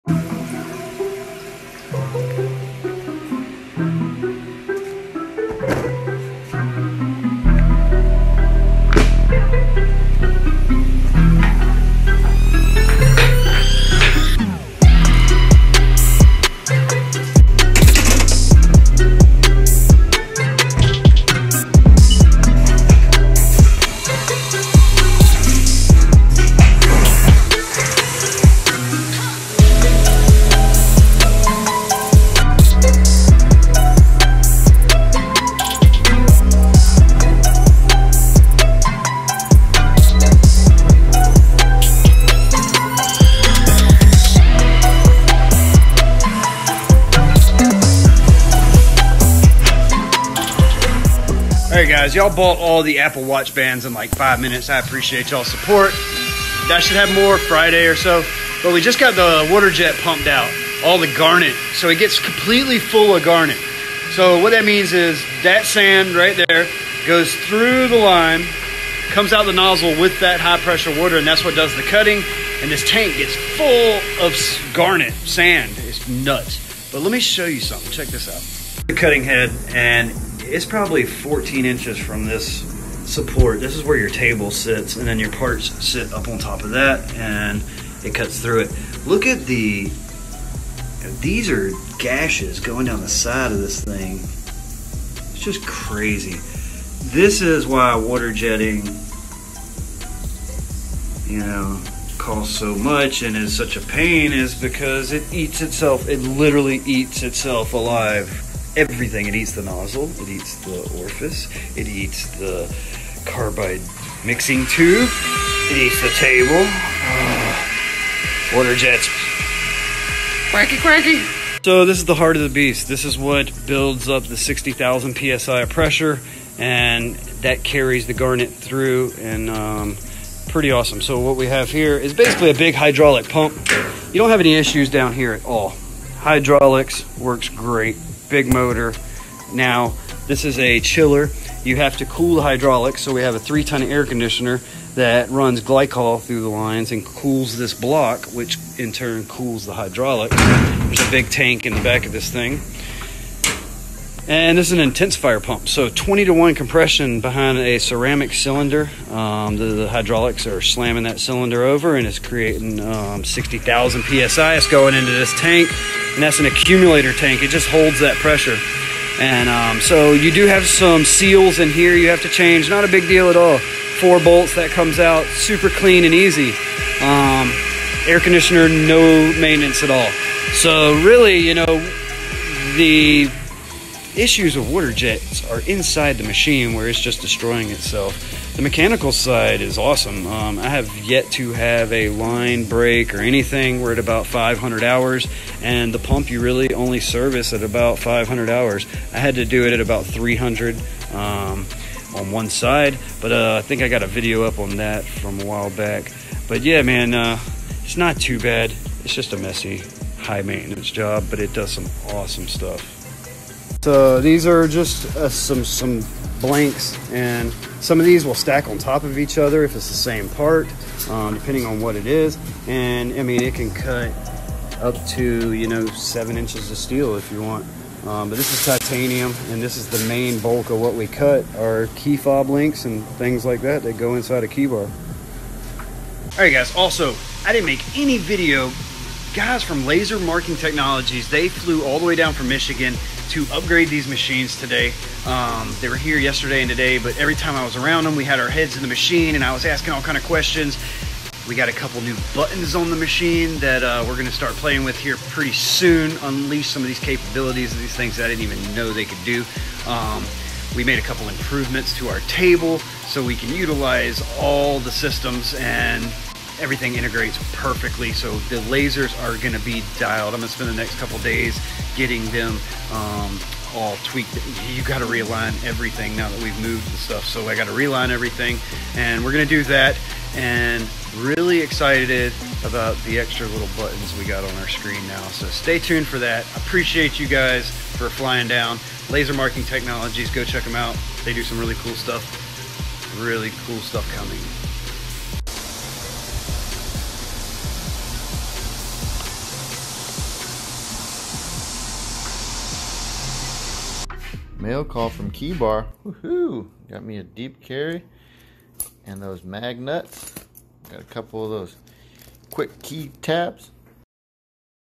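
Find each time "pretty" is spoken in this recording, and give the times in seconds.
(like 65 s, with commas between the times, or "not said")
130 s, 255 s.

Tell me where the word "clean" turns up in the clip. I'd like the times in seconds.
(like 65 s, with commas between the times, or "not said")
175 s.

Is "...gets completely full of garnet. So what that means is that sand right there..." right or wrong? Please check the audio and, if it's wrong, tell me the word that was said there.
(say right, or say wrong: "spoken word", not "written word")
right.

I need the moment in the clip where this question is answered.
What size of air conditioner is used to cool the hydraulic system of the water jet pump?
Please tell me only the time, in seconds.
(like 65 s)
143 s.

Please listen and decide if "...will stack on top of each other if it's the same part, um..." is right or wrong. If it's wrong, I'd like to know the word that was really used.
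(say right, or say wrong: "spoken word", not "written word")
right.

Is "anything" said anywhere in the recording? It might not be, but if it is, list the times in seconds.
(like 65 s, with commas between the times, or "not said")
193 s.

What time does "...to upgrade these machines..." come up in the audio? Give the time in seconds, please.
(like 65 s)
243 s.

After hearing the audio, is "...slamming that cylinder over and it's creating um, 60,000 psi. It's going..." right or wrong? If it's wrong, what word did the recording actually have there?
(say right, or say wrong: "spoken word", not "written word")
right.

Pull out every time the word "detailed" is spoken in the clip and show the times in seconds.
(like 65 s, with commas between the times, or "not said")
not said.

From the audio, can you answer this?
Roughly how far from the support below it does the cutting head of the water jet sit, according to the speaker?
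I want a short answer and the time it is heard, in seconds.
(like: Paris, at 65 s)
14 inches, at 81 s.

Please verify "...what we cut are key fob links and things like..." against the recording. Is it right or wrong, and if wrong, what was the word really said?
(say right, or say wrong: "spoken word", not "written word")
right.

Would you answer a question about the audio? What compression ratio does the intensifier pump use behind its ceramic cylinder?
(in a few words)
20 to 1.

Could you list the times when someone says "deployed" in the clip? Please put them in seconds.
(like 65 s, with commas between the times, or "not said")
not said.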